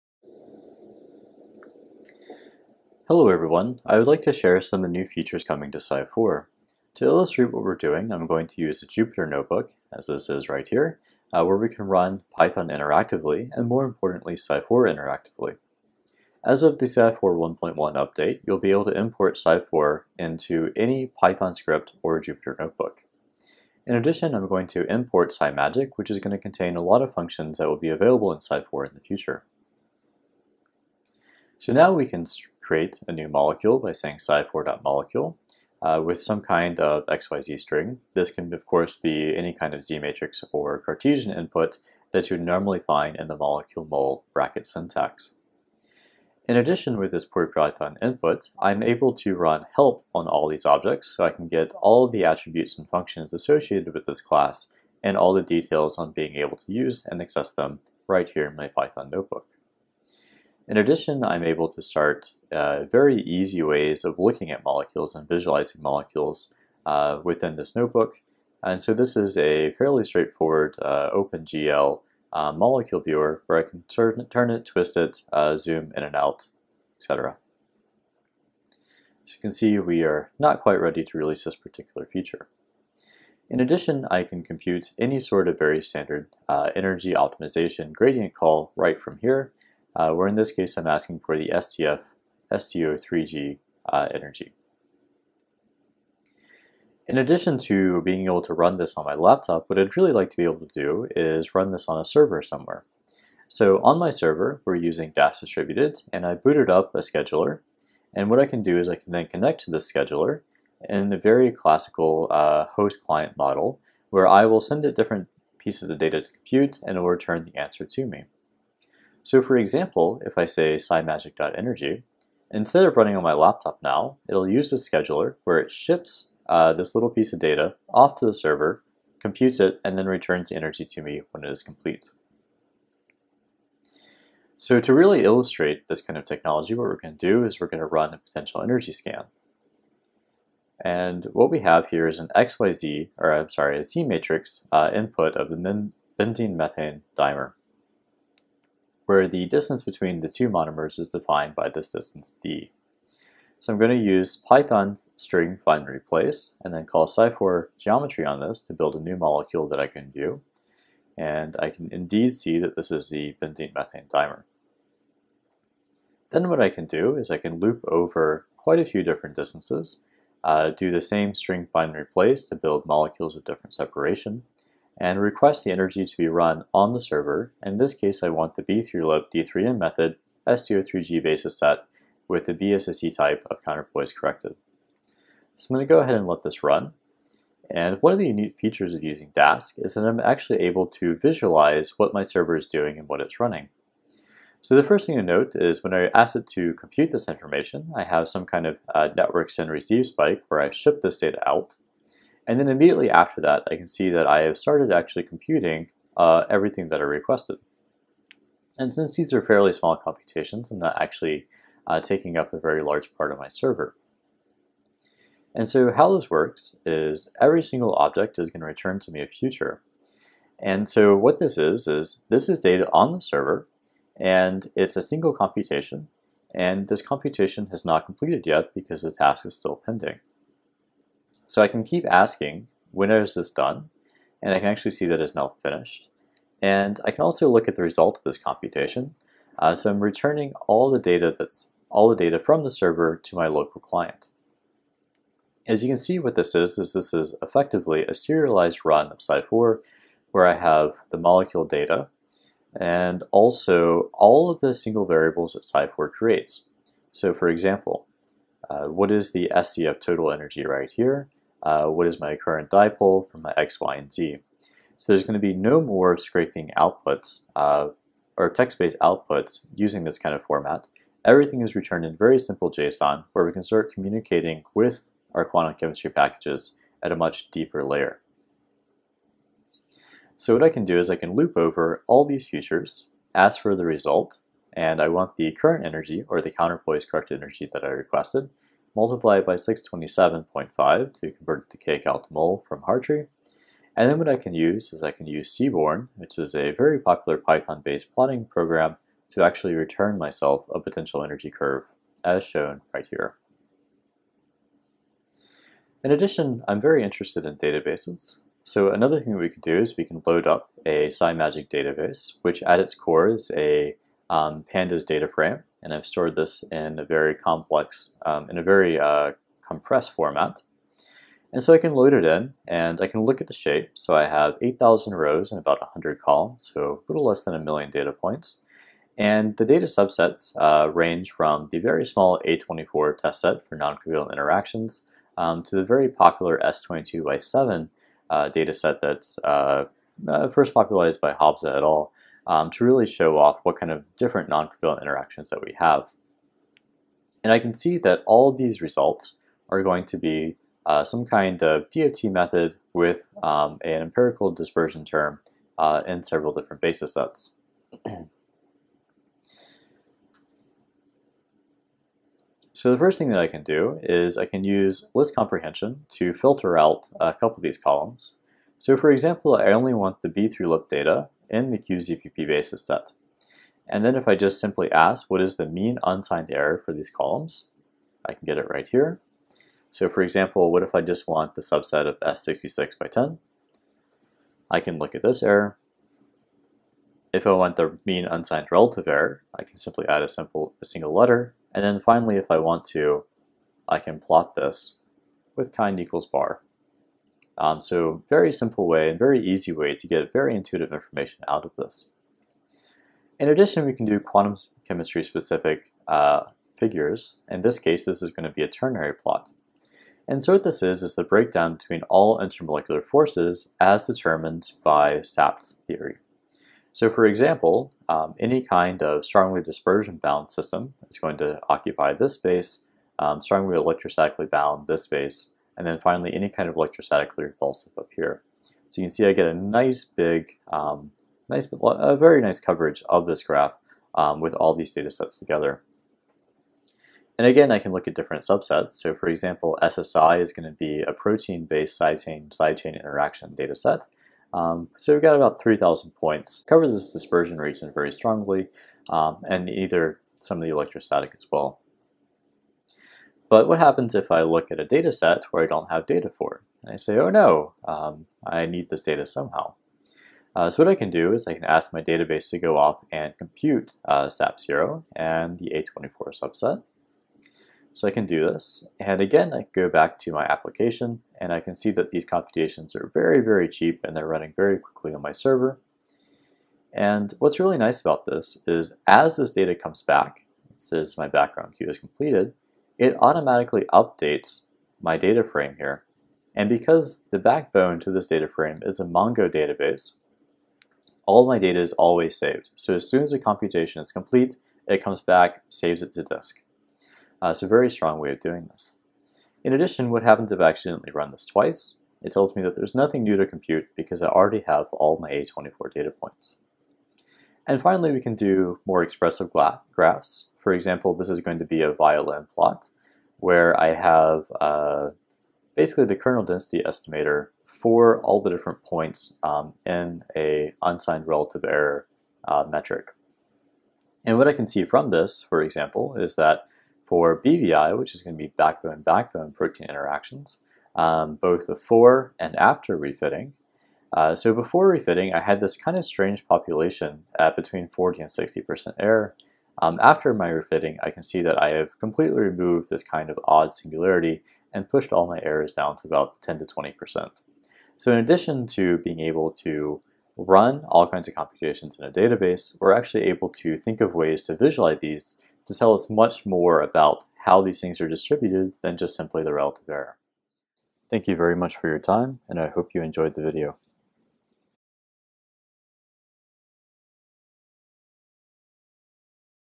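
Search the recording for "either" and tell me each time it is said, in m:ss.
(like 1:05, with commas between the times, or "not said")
7:29.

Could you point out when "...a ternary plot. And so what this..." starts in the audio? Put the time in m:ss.
6:48.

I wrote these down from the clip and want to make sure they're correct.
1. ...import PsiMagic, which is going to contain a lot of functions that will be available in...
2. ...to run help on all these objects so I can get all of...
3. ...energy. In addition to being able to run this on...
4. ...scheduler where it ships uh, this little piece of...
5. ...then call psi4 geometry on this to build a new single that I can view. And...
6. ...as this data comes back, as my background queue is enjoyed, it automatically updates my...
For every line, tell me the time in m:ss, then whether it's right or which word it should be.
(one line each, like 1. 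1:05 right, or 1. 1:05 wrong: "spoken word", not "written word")
1. 0:24 right
2. 0:49 right
3. 1:34 right
4. 2:04 right
5. 2:36 wrong: "molecule", not "single"
6. 7:59 wrong: "completed", not "enjoyed".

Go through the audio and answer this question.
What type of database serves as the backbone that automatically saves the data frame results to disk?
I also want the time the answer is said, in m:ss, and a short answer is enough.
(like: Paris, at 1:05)
Mongo database, at 8:09.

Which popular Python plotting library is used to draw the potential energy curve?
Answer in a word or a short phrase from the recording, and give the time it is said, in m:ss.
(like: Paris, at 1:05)
Seaborn, at 4:55.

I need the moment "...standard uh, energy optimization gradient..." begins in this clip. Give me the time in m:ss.
1:25.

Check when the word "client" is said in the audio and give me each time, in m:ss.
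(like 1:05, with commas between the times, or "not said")
1:52, 4:03.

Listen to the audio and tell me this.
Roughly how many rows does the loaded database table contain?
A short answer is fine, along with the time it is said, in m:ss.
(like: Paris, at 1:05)
8,000, at 5:24.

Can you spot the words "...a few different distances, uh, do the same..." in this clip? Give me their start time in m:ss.
2:48.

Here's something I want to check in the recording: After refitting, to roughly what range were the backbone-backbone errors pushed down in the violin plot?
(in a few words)
10 to 20%.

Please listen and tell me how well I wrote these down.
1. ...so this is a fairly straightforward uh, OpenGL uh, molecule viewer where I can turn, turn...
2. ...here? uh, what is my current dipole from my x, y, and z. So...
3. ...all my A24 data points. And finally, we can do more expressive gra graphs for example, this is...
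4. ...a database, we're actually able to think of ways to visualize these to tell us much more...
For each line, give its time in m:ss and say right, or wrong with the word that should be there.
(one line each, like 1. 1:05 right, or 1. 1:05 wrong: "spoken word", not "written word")
1. 1:08 right
2. 4:20 right
3. 8:24 right
4. 9:12 right.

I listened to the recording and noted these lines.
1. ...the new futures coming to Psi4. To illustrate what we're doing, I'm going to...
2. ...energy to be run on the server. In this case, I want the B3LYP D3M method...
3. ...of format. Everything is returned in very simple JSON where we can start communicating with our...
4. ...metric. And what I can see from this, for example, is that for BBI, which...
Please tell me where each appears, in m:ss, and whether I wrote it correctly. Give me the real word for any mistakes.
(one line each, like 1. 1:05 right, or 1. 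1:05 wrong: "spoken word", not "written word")
1. 0:04 wrong: "features", not "futures"
2. 2:55 right
3. 4:30 right
4. 8:42 right.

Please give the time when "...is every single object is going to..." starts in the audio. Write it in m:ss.
3:36.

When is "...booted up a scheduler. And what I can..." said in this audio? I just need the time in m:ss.
1:46.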